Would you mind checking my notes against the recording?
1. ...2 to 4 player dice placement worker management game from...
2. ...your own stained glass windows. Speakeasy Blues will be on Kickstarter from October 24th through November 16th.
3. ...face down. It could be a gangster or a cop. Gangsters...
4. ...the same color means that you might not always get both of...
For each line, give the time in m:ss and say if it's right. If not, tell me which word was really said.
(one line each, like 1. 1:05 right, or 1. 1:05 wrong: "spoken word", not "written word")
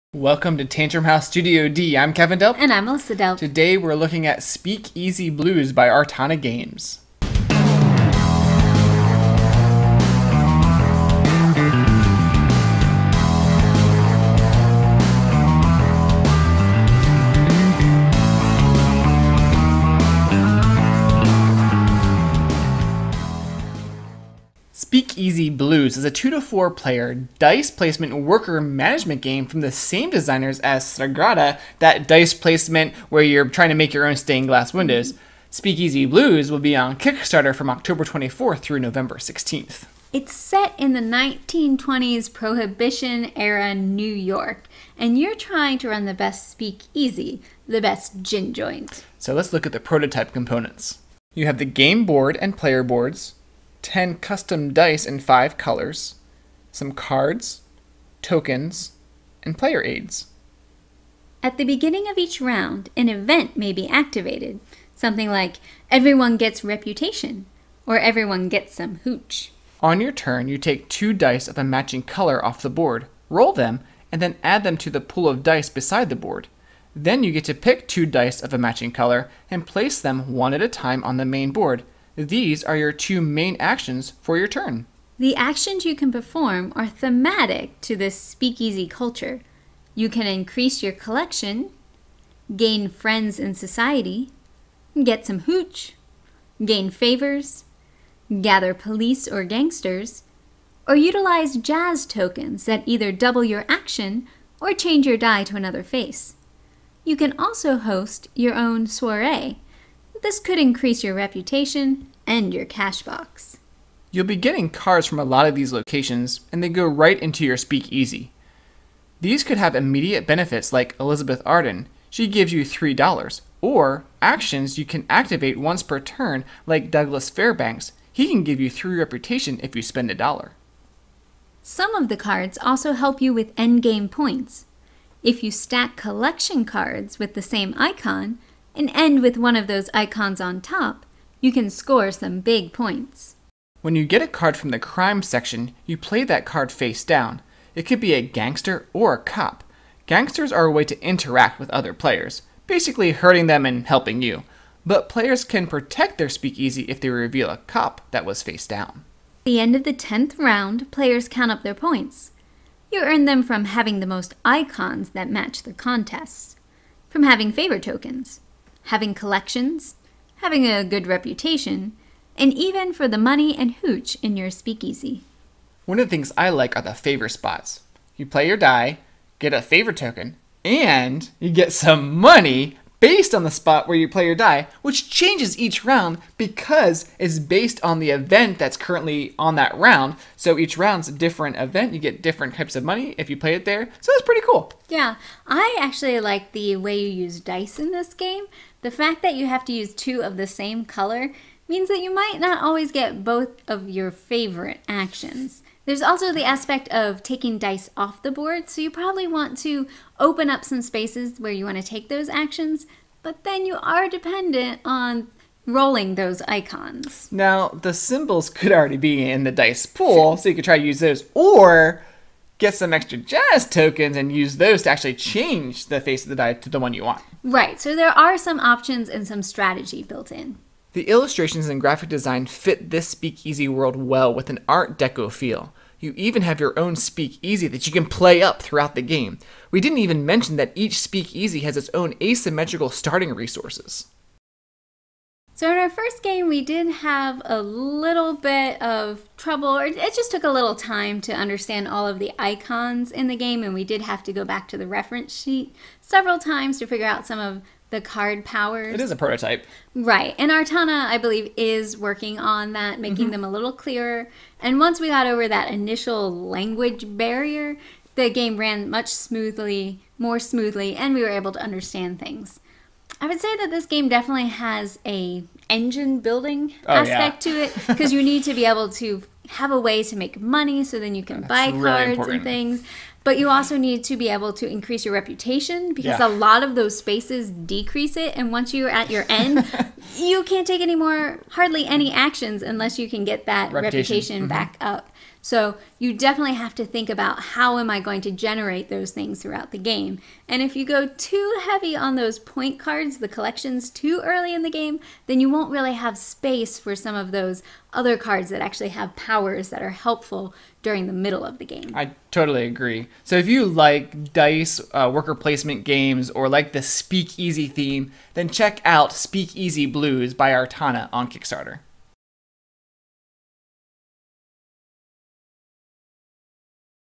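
1. 0:26 right
2. 0:33 right
3. 2:26 right
4. 3:20 right.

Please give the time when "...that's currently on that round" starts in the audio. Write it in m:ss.
3:08.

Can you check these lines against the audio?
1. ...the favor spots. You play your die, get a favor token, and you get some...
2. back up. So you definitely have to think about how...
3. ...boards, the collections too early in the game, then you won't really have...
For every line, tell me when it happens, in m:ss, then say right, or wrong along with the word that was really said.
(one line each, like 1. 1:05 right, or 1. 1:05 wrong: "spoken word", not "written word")
1. 2:56 right
2. 4:54 right
3. 5:02 wrong: "cards", not "boards".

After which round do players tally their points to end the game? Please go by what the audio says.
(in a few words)
10th.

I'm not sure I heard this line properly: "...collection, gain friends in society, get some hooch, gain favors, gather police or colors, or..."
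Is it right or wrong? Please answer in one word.
wrong.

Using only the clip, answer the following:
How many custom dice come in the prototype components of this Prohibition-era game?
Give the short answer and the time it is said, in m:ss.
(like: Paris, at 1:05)
10, at 0:53.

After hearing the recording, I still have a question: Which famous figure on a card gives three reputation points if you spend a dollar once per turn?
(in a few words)
Douglas Fairbanks.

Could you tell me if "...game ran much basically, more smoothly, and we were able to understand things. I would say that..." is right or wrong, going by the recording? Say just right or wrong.
wrong.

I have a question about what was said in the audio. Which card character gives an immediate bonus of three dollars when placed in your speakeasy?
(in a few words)
Elizabeth Arden.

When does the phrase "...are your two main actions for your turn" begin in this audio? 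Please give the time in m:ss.
1:22.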